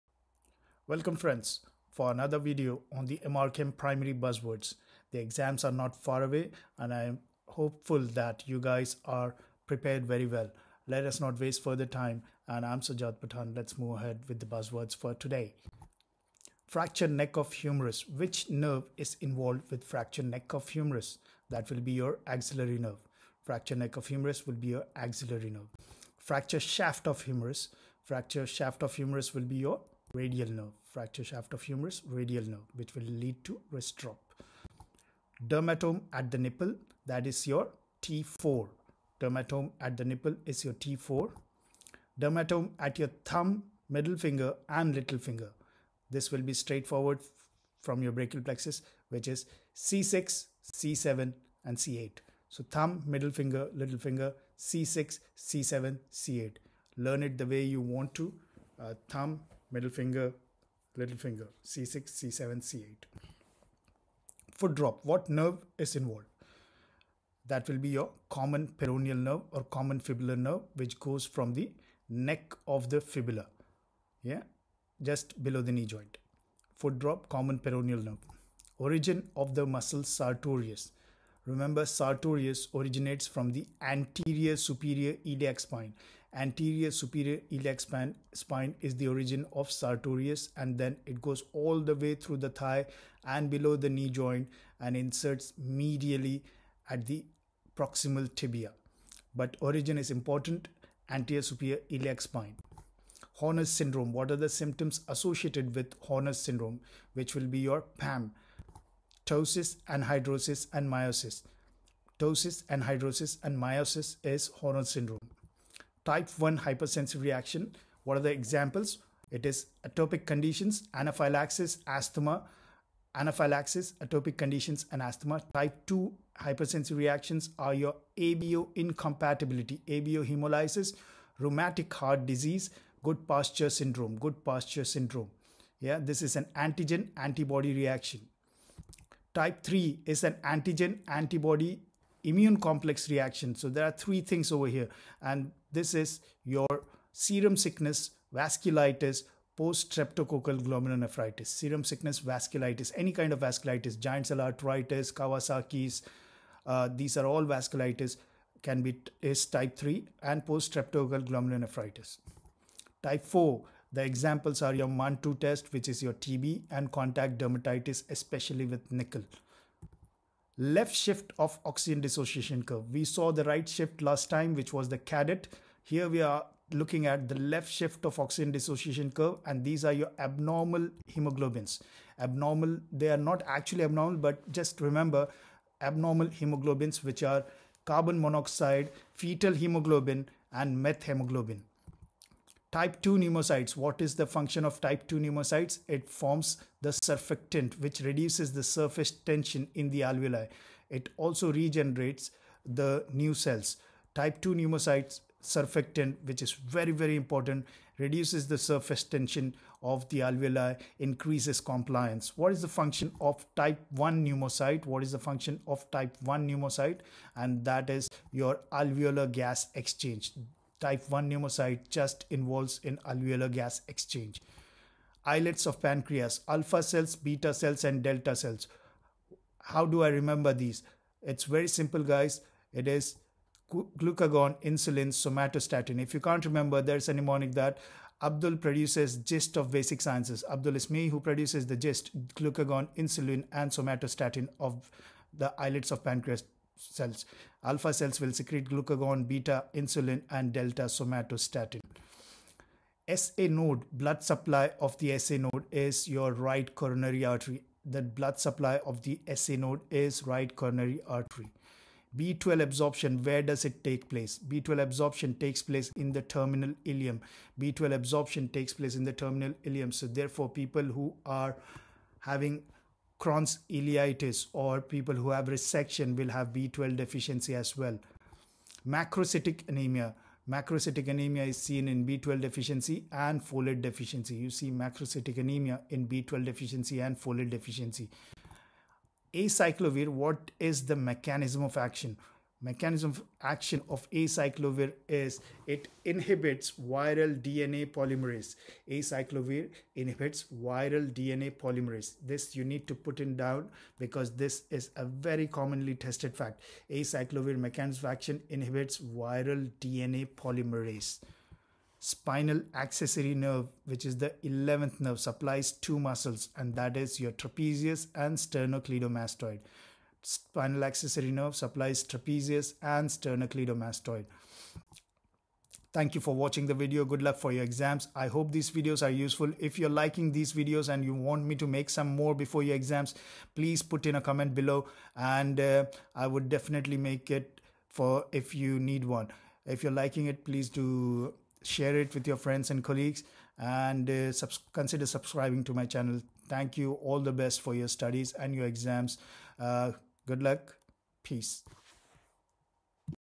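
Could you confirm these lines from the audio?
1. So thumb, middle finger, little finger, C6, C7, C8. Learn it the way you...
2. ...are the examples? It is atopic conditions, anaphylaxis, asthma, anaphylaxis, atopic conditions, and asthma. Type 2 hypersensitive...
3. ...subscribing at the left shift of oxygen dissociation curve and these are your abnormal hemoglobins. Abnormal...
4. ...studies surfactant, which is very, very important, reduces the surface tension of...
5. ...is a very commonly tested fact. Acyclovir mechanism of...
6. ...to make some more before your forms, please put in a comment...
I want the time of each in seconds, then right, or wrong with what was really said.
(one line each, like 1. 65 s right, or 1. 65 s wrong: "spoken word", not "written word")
1. 52 s right
2. 118 s right
3. 176 s wrong: "looking", not "subscribing"
4. 204 s wrong: "pneumocytes", not "studies"
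5. 304 s right
6. 331 s wrong: "exams", not "forms".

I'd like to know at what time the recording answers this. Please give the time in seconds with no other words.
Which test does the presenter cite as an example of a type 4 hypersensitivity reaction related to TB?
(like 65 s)
164 s.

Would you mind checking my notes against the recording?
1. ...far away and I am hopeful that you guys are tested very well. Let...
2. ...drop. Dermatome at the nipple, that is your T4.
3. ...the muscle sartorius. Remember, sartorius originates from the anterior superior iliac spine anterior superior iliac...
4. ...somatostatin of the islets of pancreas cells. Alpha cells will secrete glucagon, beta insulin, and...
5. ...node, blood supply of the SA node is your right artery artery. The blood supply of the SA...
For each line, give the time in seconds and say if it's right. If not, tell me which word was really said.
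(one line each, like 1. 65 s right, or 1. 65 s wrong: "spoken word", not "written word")
1. 5 s wrong: "prepared", not "tested"
2. 33 s right
3. 79 s right
4. 243 s right
5. 253 s wrong: "coronary", not "artery".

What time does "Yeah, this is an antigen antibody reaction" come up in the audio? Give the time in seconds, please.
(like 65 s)
135 s.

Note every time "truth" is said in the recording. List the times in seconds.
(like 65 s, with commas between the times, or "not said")
not said.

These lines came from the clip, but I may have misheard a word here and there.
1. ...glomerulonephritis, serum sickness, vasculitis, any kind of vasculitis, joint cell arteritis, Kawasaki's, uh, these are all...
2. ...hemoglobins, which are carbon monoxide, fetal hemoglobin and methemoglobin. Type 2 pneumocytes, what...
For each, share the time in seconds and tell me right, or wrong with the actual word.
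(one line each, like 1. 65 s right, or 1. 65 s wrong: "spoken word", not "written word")
1. 150 s wrong: "giant", not "joint"
2. 186 s right.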